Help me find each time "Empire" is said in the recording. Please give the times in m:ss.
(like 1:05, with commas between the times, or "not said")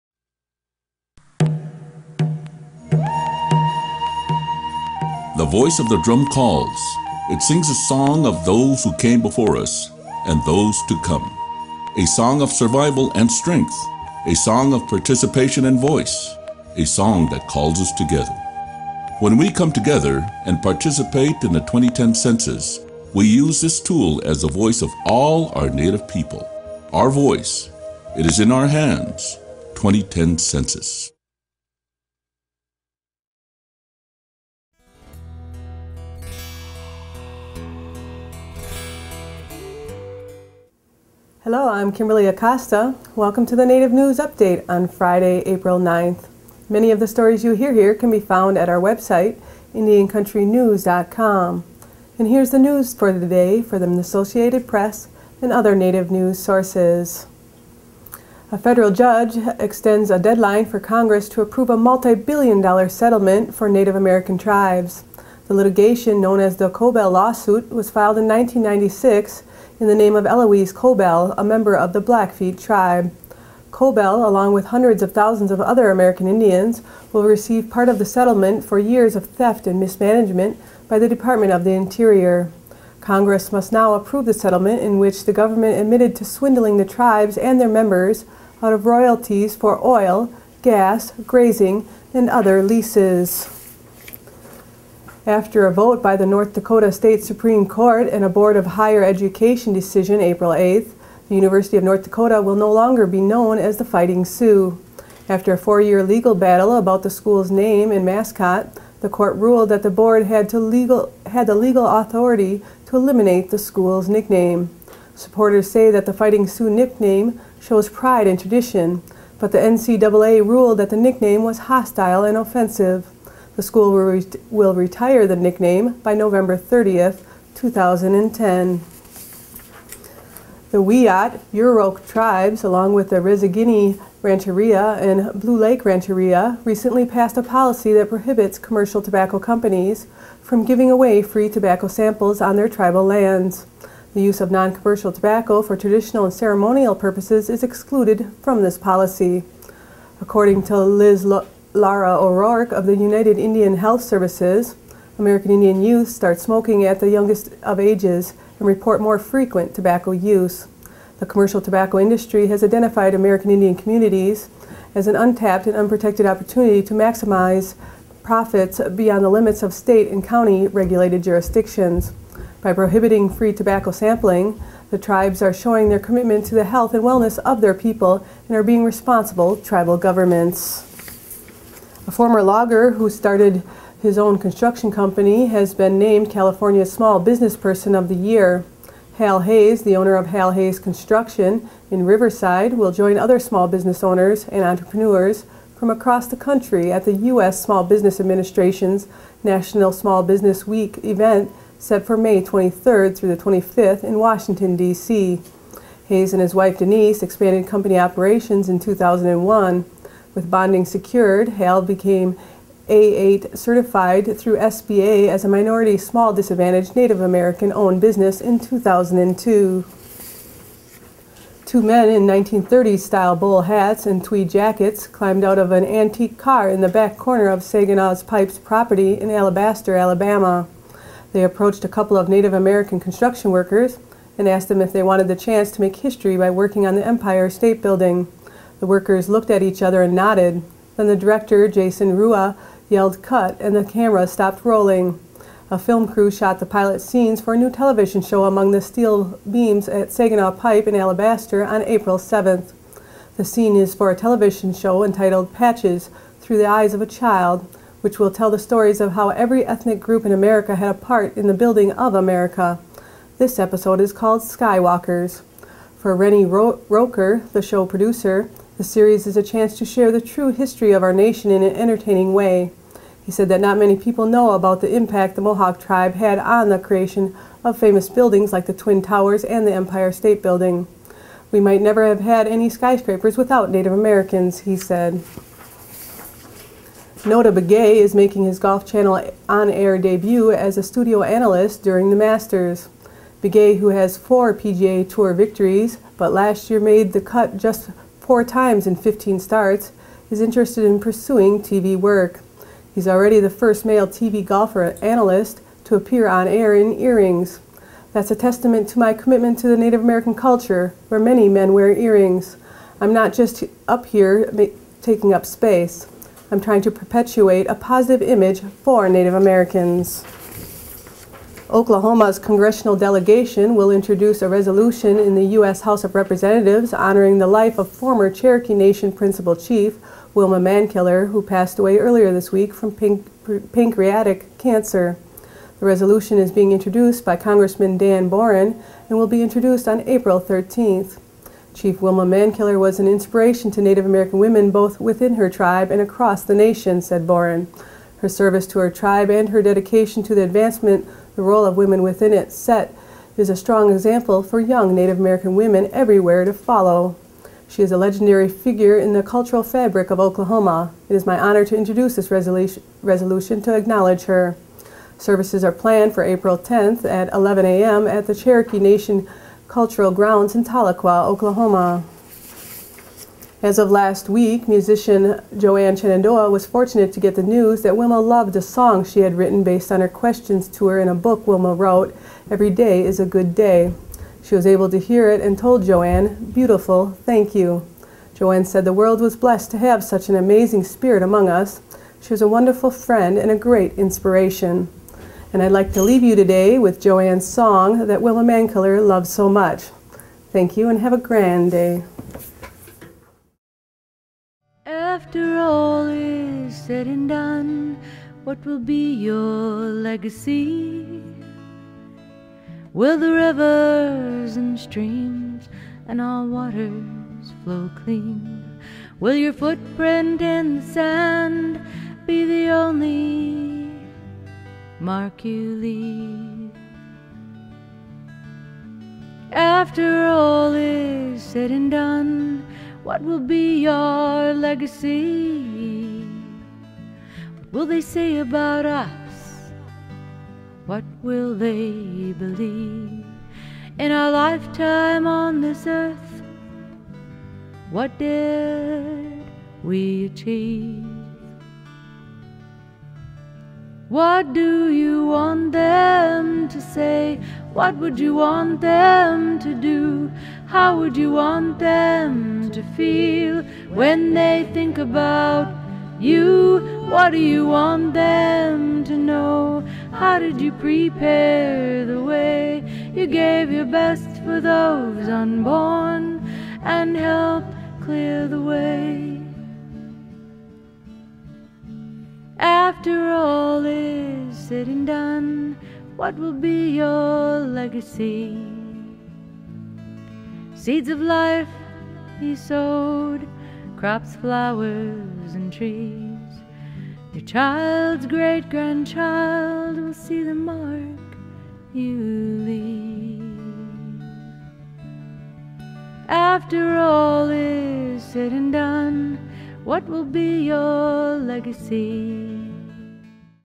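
3:57, 4:39.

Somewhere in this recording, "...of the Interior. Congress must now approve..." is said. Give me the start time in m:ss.
1:21.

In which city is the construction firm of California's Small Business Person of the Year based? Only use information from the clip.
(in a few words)
Riverside.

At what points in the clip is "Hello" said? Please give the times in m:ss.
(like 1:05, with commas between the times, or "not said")
0:41.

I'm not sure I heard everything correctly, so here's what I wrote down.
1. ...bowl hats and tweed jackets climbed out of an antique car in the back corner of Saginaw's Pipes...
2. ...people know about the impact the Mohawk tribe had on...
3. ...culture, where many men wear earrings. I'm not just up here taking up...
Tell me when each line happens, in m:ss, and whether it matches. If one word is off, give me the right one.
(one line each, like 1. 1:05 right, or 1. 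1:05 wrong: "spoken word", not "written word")
1. 3:43 right
2. 4:33 right
3. 5:10 right.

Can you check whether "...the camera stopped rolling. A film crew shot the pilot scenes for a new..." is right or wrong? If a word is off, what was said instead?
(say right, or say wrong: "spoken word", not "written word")
right.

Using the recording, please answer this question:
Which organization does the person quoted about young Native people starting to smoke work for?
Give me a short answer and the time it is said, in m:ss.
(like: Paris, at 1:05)
United Indian Health Services, at 2:32.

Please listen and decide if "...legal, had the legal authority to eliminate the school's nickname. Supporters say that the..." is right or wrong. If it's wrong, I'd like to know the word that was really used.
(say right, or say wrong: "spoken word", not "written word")
right.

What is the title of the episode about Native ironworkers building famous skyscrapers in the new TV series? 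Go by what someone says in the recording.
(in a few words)
Skywalkers.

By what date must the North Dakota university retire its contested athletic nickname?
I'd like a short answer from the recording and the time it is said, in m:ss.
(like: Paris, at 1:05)
November 30th, 2010, at 2:06.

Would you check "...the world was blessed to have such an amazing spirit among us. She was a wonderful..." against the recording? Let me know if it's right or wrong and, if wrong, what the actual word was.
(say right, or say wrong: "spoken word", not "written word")
right.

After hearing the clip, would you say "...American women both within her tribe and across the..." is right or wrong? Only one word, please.
right.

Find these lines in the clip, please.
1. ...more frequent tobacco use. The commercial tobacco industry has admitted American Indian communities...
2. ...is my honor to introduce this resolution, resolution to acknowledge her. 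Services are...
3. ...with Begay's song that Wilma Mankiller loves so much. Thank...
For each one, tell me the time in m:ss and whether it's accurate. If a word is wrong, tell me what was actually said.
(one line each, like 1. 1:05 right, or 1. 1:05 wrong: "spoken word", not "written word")
1. 2:38 wrong: "identified", not "admitted"
2. 6:01 right
3. 6:36 wrong: "Joanne", not "Begay".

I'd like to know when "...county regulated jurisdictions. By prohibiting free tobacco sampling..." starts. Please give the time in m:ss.
2:50.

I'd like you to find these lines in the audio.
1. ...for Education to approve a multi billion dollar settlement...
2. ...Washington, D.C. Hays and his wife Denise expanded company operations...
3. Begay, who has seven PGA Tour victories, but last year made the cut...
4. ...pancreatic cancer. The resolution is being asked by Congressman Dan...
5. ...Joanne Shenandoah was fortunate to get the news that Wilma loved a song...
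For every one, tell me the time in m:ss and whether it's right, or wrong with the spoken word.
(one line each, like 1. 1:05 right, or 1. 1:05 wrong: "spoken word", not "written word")
1. 1:00 wrong: "Congress", not "Education"
2. 3:24 right
3. 4:53 wrong: "four", not "seven"
4. 5:33 wrong: "introduced", not "asked"
5. 6:15 right.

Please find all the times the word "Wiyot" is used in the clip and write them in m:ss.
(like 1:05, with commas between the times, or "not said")
2:10.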